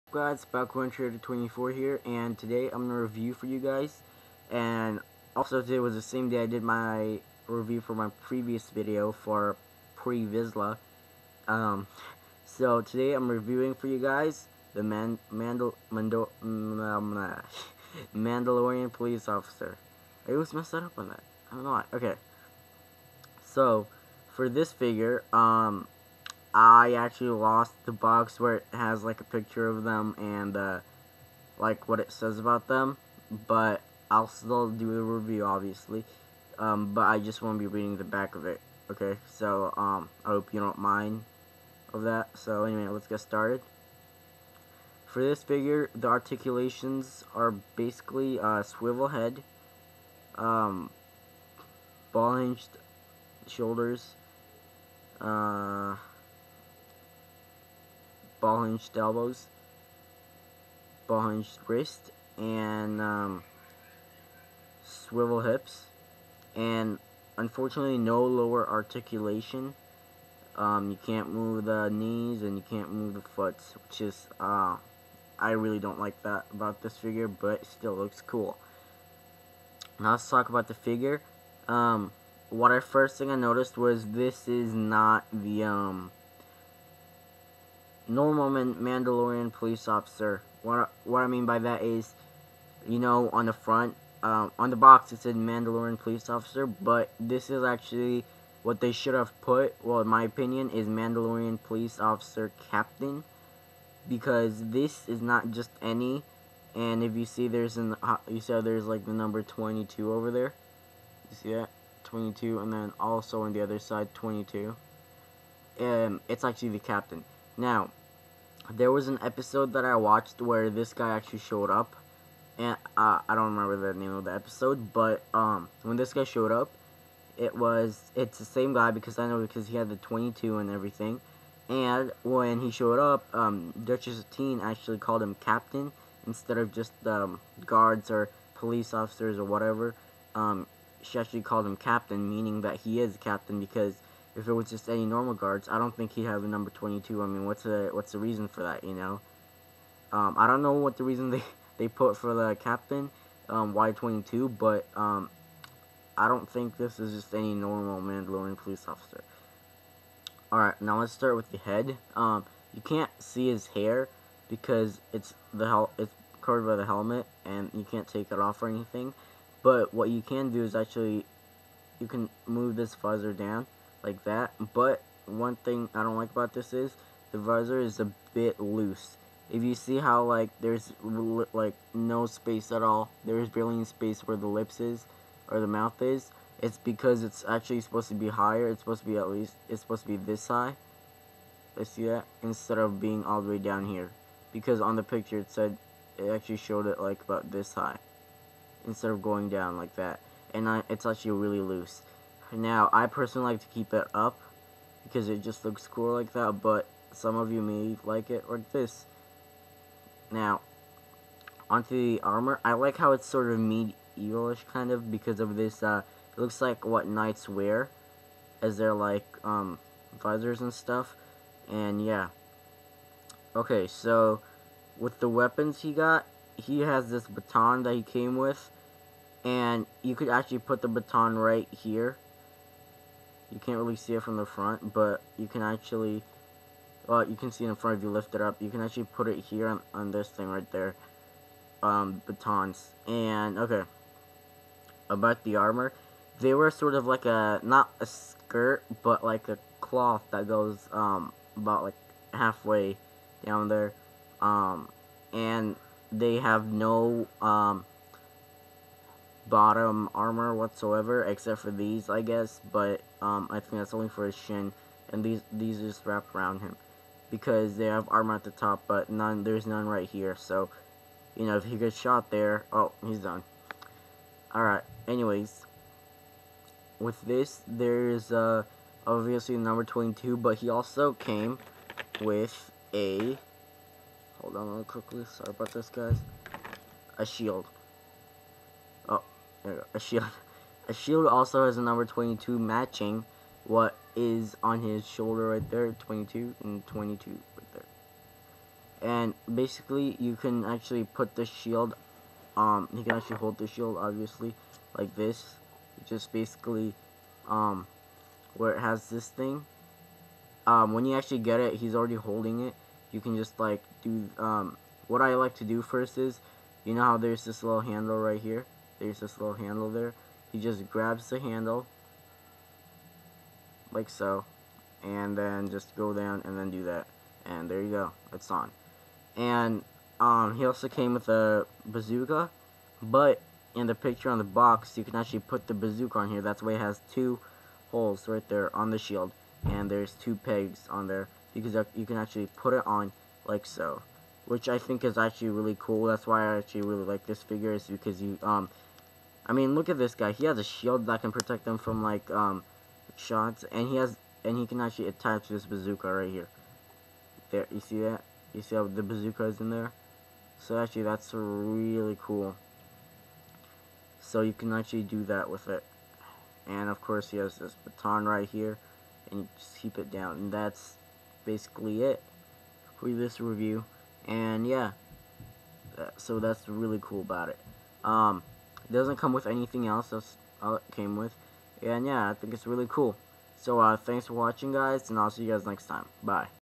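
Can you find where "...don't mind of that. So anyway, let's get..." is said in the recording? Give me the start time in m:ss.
0:40.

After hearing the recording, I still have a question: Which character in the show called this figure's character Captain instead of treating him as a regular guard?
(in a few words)
Duchess Satine.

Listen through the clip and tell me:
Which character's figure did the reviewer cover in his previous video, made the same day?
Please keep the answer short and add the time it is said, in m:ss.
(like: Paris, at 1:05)
Pre-Vizsla, at 0:09.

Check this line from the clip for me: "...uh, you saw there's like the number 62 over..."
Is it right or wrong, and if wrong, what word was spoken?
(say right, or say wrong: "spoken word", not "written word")
wrong: "22", not "62".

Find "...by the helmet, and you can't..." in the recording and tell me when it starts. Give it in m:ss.
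2:46.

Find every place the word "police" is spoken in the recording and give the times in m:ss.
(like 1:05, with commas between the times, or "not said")
0:18, 1:29, 1:35, 1:41, 2:18, 2:38.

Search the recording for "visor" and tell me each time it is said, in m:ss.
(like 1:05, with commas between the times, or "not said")
2:52, 2:57, 3:40.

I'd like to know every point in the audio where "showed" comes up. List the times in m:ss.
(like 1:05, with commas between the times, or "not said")
2:01, 2:06, 2:12, 3:16.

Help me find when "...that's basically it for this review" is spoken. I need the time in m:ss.
6:10.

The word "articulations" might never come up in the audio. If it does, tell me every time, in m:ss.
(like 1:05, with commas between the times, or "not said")
0:46, 1:08.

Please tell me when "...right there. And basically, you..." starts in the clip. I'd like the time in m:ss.
4:57.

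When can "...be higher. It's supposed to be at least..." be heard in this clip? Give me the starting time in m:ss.
3:08.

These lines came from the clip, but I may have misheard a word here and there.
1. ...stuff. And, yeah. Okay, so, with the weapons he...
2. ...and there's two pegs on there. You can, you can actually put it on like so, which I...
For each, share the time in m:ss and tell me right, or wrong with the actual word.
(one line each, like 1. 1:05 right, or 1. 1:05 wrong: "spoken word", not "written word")
1. 3:40 right
2. 5:39 right.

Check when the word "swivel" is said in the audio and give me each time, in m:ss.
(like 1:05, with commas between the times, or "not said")
0:48, 1:04.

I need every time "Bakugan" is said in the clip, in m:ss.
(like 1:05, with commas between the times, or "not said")
0:00.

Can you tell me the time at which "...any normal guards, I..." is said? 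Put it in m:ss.
2:24.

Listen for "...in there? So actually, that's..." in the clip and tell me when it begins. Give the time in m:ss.
5:59.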